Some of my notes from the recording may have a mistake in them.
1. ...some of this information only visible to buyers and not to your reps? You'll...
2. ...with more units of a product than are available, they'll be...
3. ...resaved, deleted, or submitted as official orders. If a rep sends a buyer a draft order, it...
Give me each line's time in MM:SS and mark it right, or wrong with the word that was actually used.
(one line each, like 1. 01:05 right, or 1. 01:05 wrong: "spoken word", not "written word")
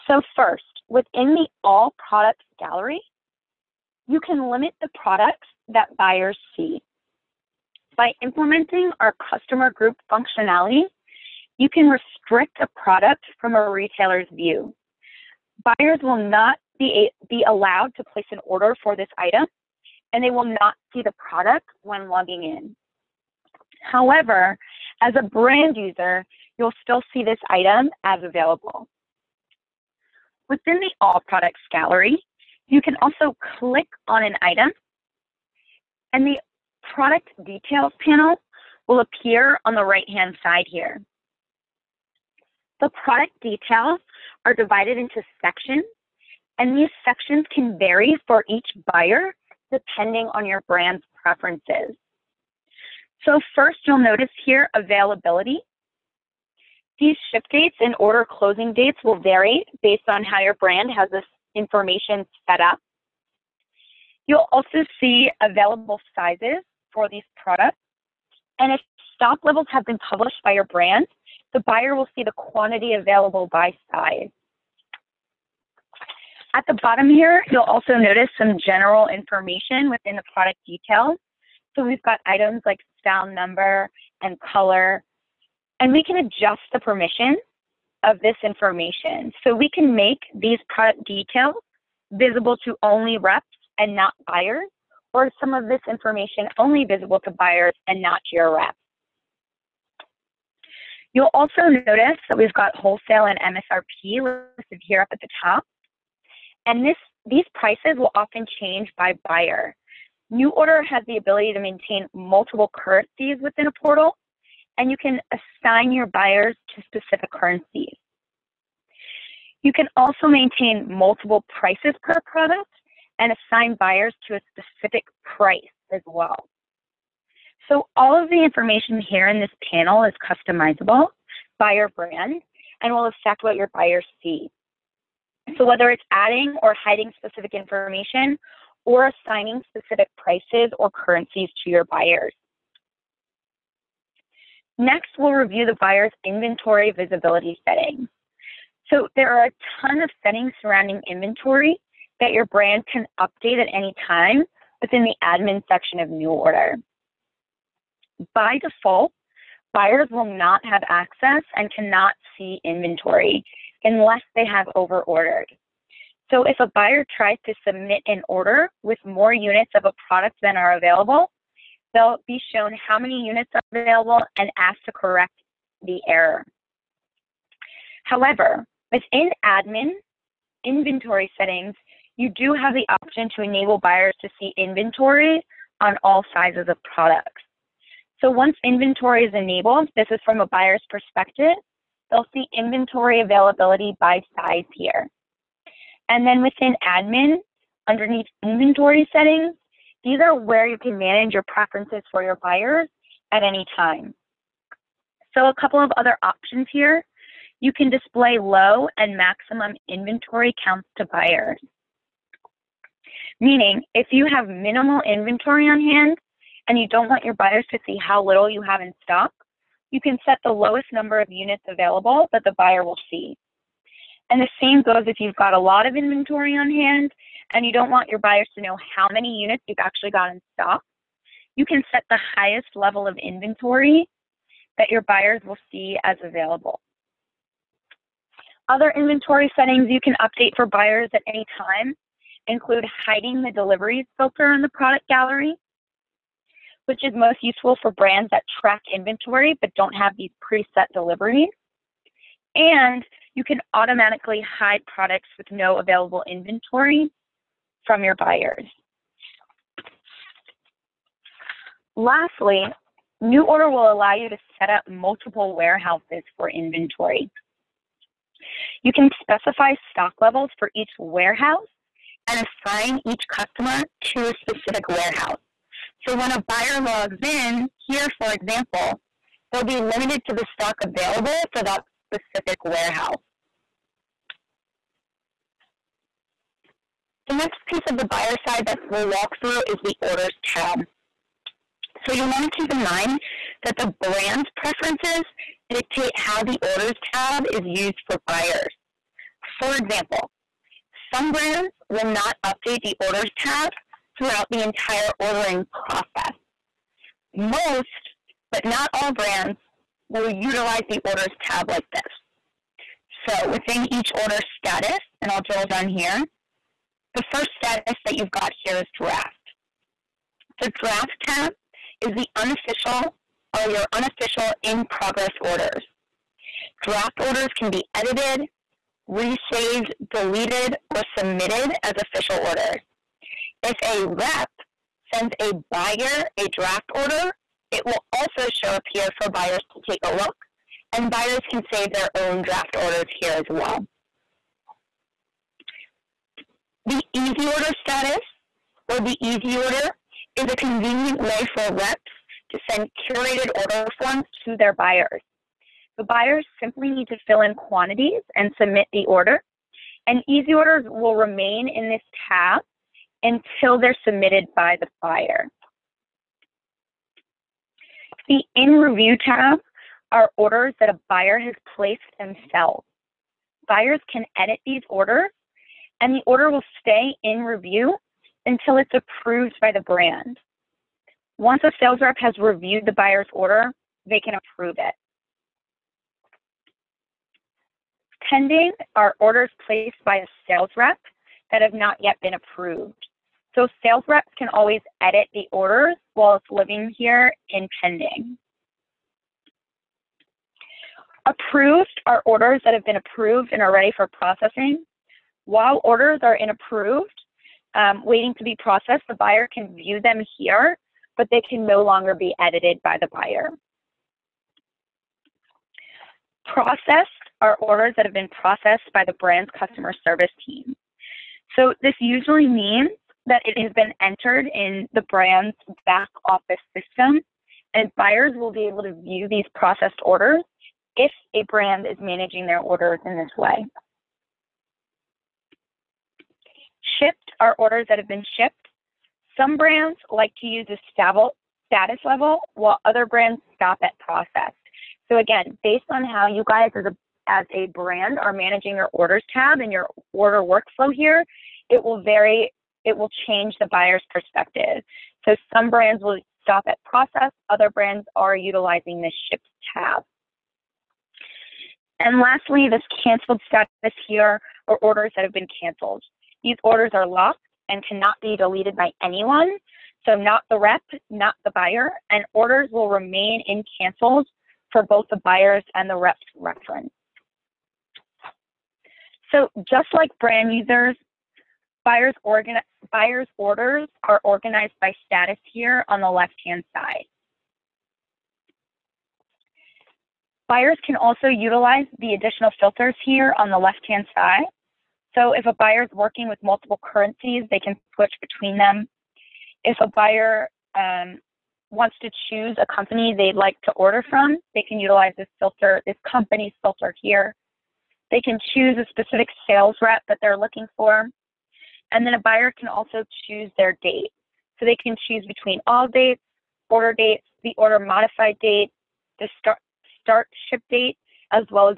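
1. 01:35 right
2. 02:48 right
3. 05:29 right.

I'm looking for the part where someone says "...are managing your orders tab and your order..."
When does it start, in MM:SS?
07:28.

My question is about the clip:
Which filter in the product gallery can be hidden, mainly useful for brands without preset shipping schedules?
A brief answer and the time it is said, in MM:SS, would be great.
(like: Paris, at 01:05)
Deliveries filter, at 04:03.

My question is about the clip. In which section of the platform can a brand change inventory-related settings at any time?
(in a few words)
Admin section.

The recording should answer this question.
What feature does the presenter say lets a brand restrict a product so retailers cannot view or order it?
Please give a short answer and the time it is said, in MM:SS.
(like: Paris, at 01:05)
Customer group functionality, at 00:09.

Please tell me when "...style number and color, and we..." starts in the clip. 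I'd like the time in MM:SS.
01:23.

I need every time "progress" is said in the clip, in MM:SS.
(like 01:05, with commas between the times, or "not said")
05:24.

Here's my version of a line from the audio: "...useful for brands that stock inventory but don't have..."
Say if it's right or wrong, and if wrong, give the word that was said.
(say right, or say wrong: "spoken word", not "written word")
wrong: "track", not "stock".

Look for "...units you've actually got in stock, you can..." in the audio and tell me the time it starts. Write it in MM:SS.
03:49.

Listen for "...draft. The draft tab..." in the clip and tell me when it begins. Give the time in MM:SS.
05:19.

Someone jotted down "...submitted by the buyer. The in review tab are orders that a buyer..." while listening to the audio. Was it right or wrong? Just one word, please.
right.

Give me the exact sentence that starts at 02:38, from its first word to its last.
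By default, buyers will not have access and cannot see inventory unless they have over ordered.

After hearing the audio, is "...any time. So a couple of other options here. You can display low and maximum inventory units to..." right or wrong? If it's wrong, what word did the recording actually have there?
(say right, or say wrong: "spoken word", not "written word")
wrong: "counts", not "units".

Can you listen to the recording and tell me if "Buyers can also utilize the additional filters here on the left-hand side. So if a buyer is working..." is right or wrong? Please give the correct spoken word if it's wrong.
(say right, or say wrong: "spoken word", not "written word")
right.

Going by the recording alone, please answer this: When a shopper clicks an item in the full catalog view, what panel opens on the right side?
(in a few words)
Product details panel.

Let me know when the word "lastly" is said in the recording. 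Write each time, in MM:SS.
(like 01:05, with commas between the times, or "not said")
04:21, 07:42.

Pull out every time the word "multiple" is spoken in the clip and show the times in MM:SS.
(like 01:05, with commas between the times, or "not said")
01:52, 02:00, 04:24, 08:16.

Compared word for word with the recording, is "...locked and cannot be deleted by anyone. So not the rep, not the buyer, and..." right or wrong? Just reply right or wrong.
right.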